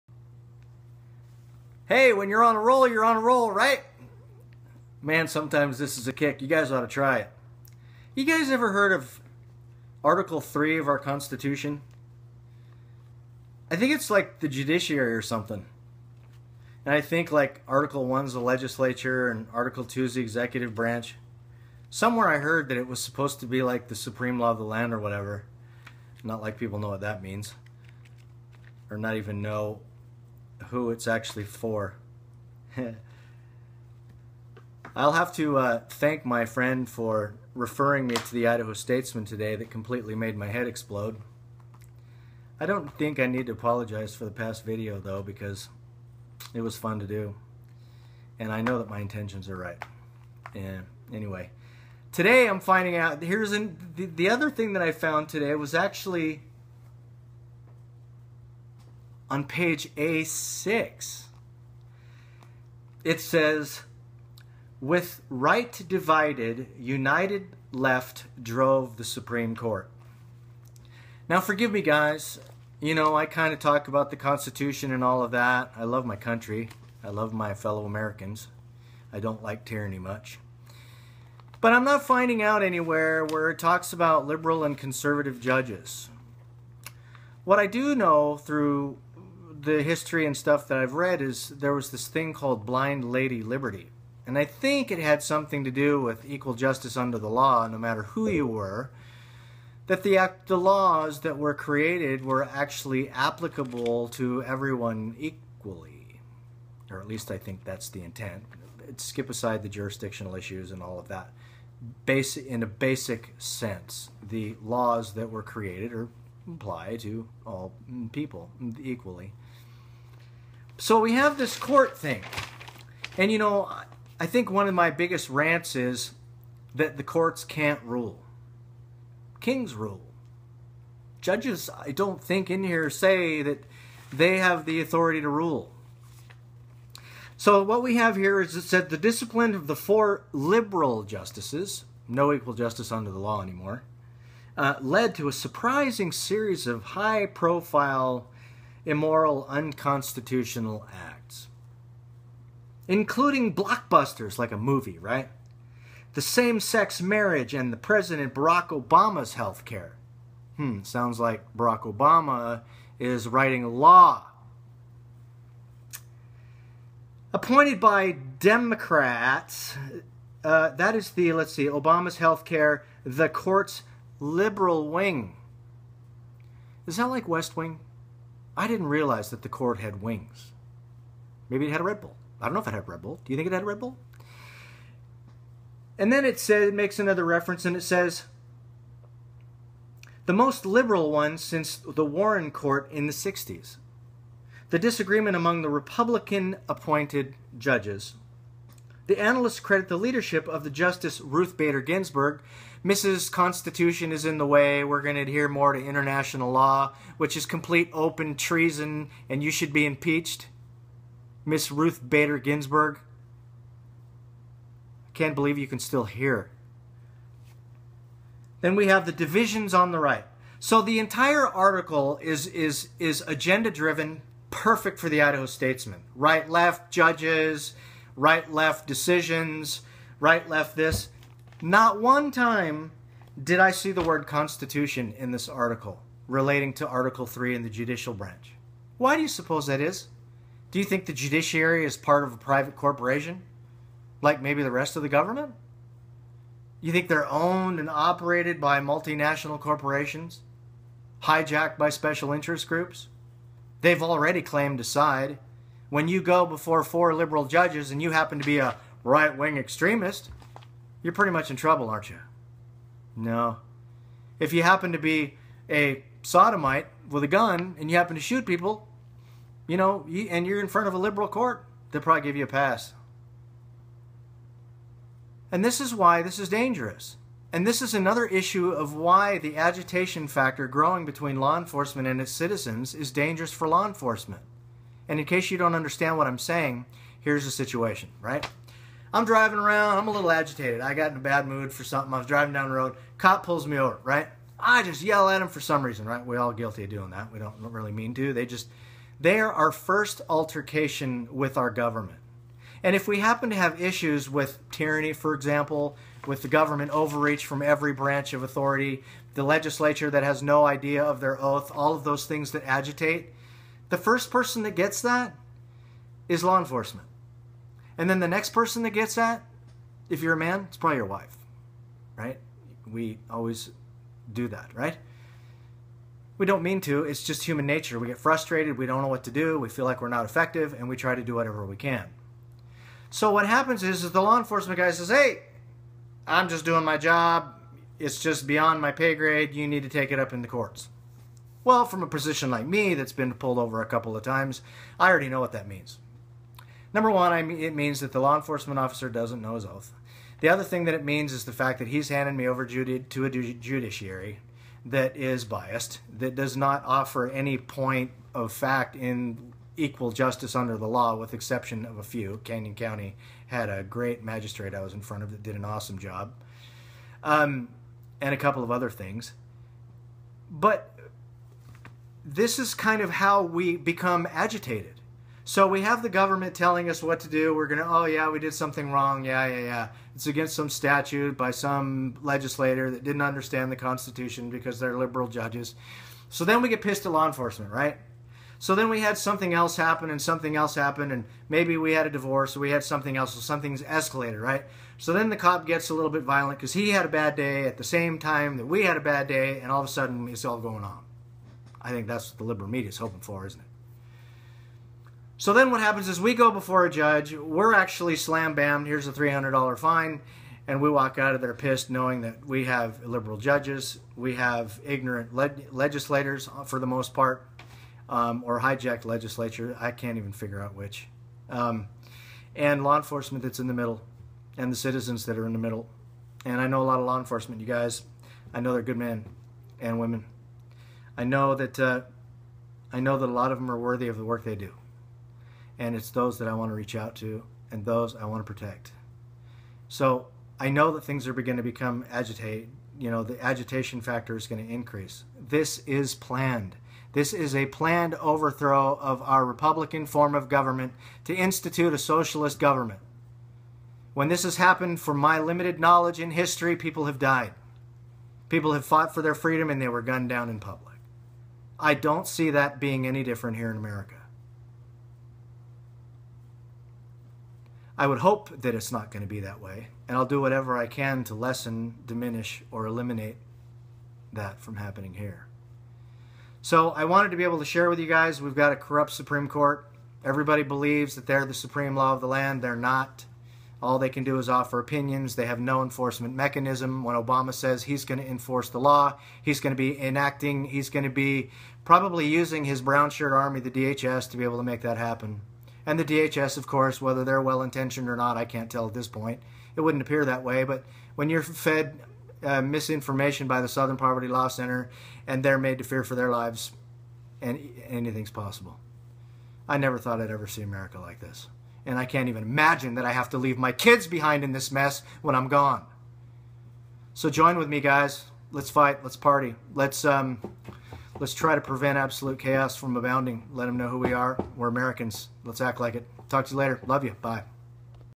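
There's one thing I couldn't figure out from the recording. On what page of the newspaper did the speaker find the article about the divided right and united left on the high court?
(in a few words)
A6.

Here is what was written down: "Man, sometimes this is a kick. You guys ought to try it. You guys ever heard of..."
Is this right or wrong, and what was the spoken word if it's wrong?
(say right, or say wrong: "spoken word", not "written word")
right.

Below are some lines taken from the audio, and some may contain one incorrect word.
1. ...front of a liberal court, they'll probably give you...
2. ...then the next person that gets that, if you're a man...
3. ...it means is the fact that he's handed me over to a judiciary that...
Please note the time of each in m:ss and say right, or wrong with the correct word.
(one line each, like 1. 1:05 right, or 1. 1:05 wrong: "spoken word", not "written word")
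1. 4:30 right
2. 5:18 right
3. 5:50 right.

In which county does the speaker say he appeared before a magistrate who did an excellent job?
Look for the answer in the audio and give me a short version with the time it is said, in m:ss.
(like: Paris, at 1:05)
Canyon County, at 6:02.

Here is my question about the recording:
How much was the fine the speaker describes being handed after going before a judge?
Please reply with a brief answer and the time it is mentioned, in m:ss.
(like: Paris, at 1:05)
$300, at 6:49.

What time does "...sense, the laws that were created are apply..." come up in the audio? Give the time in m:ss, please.
1:53.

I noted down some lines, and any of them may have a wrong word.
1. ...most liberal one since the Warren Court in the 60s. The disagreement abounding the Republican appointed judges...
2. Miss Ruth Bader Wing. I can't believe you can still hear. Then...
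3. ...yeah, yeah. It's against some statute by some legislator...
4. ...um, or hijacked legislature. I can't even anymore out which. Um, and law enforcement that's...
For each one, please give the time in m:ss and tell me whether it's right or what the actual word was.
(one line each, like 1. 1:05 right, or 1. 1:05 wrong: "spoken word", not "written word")
1. 3:10 wrong: "among", not "abounding"
2. 3:31 wrong: "Ginsburg", not "Wing"
3. 6:19 right
4. 6:58 wrong: "figure", not "anymore".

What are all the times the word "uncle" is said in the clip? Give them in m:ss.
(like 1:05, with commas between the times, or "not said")
not said.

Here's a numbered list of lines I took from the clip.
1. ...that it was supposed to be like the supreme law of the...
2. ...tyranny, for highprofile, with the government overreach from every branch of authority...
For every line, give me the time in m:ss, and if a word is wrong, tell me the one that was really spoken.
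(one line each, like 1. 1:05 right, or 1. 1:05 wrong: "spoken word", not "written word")
1. 0:22 right
2. 5:04 wrong: "example", not "highprofile".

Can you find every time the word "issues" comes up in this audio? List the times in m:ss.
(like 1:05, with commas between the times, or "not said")
1:50, 4:38, 5:03.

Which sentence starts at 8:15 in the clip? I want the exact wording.
And the DHS, of course, whether they're well intentioned or not, I can't tell at this point.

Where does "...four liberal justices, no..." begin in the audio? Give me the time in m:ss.
2:19.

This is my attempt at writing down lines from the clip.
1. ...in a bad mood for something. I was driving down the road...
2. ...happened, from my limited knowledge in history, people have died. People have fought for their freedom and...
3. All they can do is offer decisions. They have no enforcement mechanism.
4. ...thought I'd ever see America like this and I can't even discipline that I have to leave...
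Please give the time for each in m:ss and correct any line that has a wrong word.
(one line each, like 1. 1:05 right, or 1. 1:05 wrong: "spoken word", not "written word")
1. 4:51 right
2. 7:34 right
3. 8:03 wrong: "opinions", not "decisions"
4. 8:29 wrong: "imagine", not "discipline".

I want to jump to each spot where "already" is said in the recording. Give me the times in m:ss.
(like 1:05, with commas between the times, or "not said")
4:14, 5:45.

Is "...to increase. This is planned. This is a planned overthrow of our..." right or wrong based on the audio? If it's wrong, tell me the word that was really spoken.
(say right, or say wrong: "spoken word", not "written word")
right.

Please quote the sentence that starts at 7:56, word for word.
So I wanted to be able to share with you guys we've got a corrupt Supreme Court.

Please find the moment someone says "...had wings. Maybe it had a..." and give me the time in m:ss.
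2:59.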